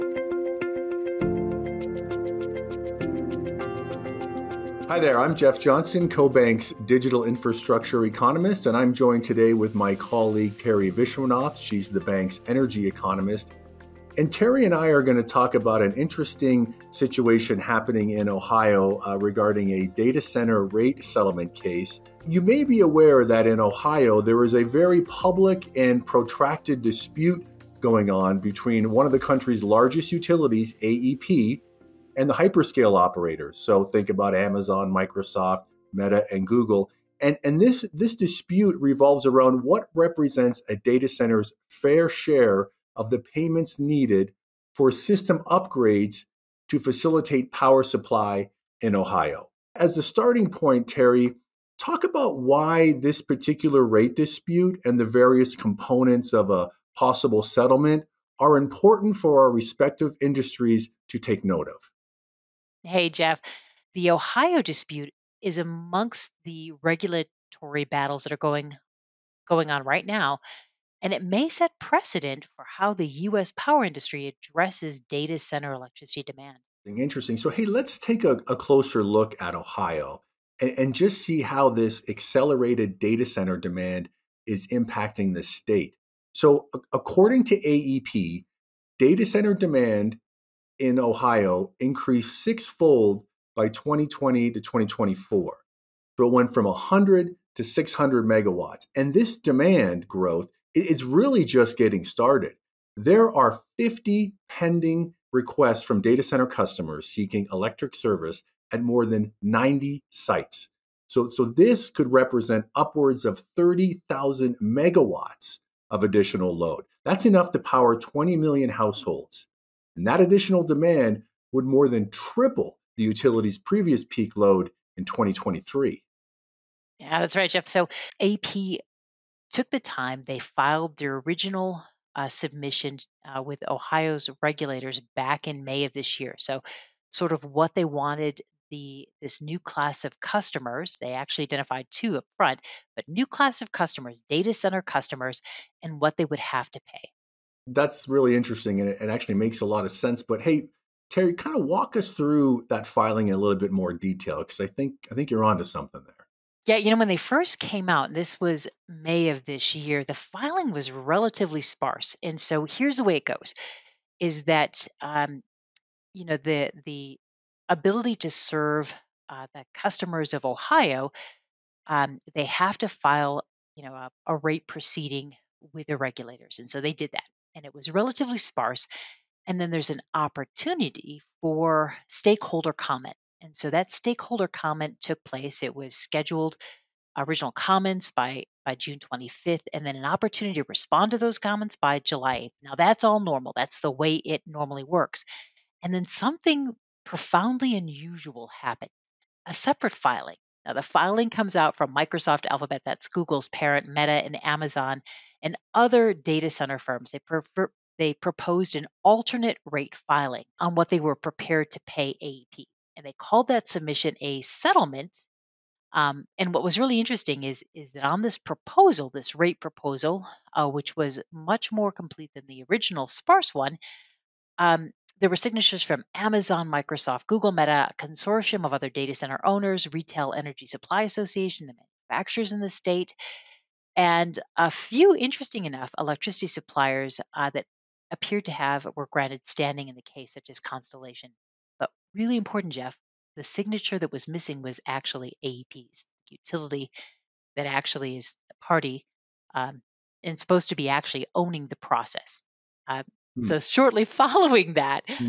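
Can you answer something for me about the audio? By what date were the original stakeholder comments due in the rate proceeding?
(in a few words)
June 25.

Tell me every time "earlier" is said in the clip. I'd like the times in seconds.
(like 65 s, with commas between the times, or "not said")
not said.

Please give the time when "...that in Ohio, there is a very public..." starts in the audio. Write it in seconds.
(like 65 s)
23 s.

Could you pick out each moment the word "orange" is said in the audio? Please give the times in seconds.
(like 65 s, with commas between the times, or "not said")
not said.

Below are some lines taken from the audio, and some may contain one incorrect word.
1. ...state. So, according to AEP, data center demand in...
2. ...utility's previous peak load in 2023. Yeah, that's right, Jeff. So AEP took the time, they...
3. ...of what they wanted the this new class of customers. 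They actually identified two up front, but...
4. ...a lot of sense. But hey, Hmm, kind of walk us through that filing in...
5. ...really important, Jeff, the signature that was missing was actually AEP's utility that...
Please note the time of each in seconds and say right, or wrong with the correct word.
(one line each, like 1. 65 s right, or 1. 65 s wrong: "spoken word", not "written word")
1. 85 s right
2. 123 s right
3. 137 s right
4. 149 s wrong: "Teri", not "Hmm"
5. 242 s right.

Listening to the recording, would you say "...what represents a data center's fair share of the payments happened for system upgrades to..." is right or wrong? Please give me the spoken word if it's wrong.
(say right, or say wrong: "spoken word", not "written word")
wrong: "needed", not "happened".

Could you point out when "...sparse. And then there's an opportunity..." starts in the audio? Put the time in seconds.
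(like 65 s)
178 s.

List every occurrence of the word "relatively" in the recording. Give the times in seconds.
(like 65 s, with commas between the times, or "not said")
160 s, 177 s.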